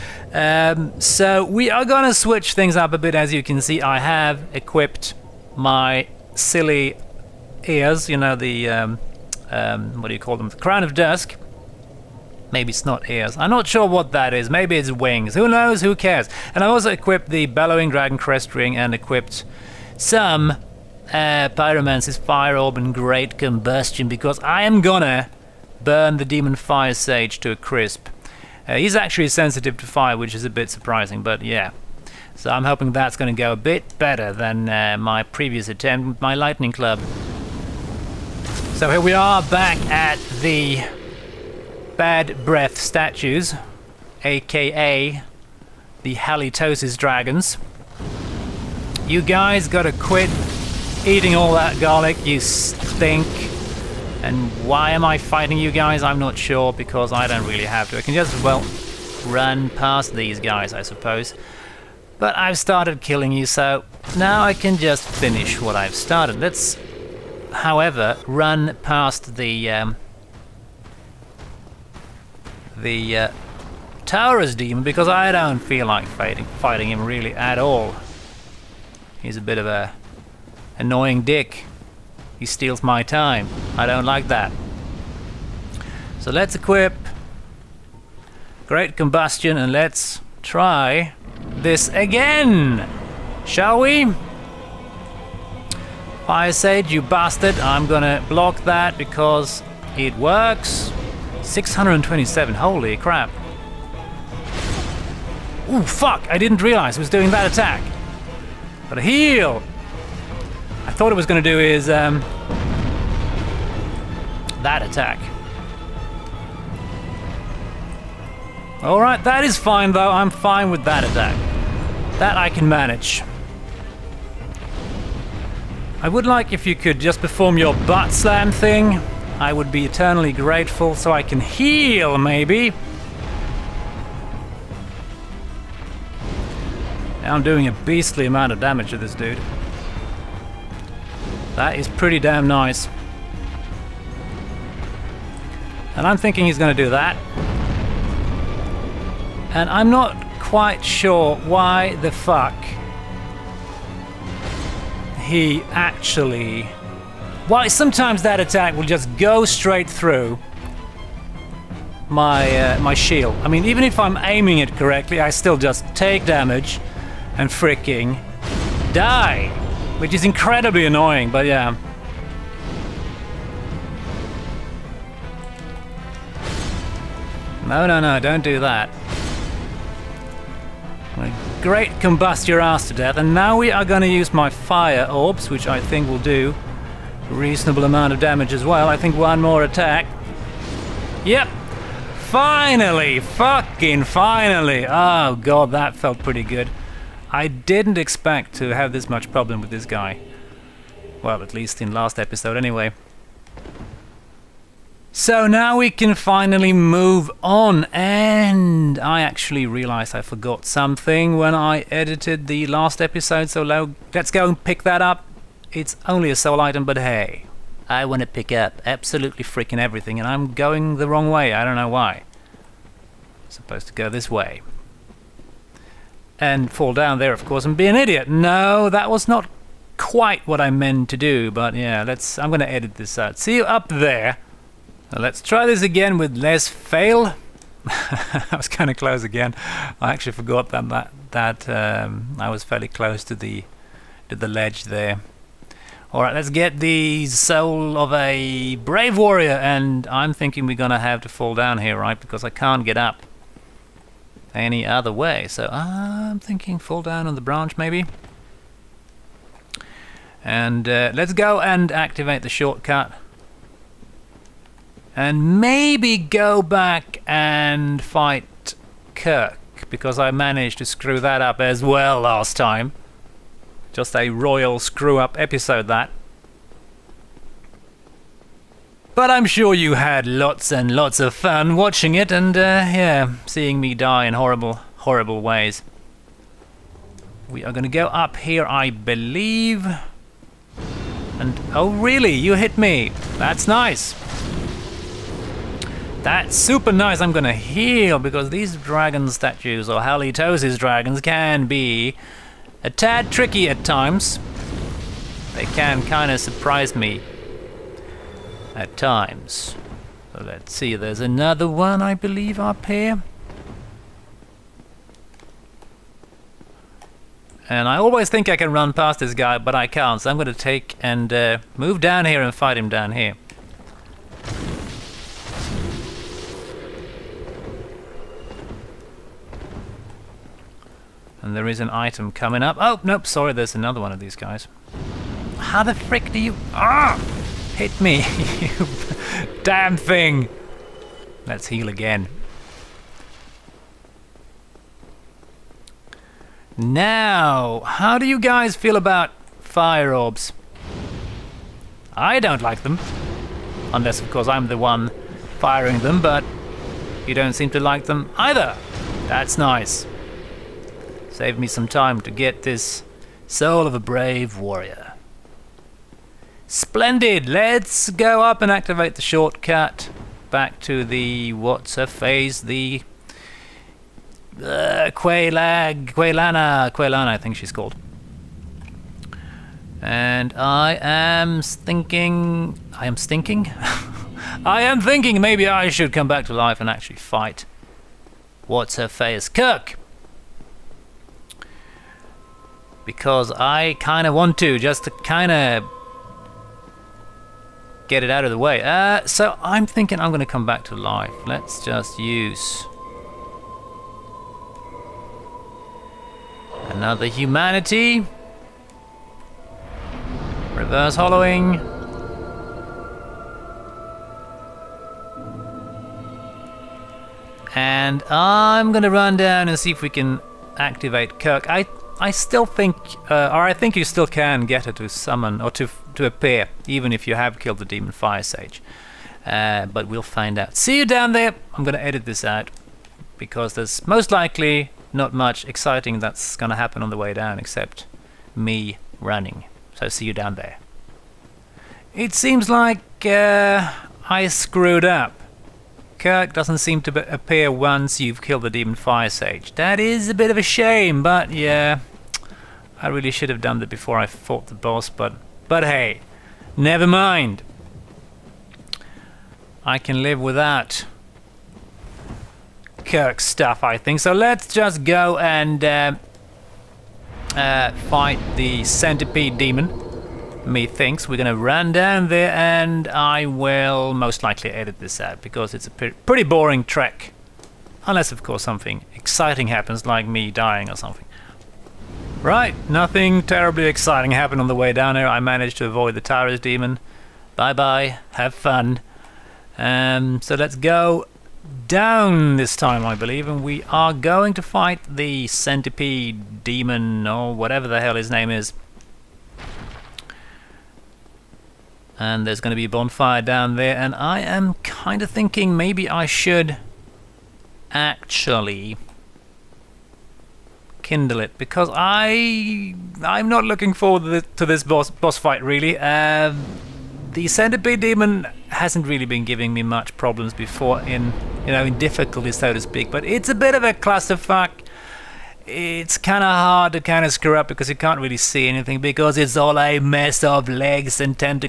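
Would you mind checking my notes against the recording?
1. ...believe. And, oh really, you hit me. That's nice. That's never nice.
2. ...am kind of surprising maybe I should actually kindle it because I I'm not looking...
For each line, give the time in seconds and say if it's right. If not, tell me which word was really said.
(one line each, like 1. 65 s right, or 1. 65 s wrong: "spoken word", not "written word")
1. 288 s wrong: "super", not "never"
2. 504 s wrong: "thinking", not "surprising".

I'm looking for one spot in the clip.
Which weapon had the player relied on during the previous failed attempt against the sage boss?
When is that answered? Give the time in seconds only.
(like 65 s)
36 s.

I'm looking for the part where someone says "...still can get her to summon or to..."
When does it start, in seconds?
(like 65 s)
424 s.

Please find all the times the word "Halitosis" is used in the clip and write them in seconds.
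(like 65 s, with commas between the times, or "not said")
46 s, 299 s.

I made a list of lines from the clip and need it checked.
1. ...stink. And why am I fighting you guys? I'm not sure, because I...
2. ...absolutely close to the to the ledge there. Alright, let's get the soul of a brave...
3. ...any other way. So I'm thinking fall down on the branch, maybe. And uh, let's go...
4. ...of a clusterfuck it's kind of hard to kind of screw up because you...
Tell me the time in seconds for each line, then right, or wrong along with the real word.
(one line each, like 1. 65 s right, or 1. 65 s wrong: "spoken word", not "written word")
1. 52 s right
2. 242 s wrong: "fairly", not "absolutely"
3. 254 s right
4. 523 s right.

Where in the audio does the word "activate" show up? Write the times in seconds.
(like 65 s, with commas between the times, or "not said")
261 s, 368 s, 420 s.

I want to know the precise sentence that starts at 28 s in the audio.
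Uh, he's actually sensitive to fire, which is a bit surprising, but yeah.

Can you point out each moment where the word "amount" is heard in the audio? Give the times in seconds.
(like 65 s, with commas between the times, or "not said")
138 s, 187 s.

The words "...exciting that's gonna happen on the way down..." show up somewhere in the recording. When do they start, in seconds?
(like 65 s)
435 s.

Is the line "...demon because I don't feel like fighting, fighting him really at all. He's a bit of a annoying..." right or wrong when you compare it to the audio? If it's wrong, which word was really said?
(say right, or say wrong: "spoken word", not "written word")
right.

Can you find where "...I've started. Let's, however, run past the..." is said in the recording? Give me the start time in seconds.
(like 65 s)
65 s.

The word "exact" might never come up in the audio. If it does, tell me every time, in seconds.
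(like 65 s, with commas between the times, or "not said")
not said.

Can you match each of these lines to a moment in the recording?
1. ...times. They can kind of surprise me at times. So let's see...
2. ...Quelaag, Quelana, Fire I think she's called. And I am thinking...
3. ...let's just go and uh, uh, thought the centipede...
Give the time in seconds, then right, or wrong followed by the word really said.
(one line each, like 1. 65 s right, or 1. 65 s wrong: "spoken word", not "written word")
1. 303 s right
2. 375 s wrong: "Quelana", not "Fire"
3. 464 s wrong: "fight", not "thought".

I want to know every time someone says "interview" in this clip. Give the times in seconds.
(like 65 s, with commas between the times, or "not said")
not said.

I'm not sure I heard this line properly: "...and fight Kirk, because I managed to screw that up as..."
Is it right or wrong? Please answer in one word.
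right.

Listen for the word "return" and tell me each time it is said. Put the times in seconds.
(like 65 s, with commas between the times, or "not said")
not said.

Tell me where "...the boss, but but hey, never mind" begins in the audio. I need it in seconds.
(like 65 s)
454 s.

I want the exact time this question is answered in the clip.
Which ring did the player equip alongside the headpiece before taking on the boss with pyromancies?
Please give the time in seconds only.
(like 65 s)
17 s.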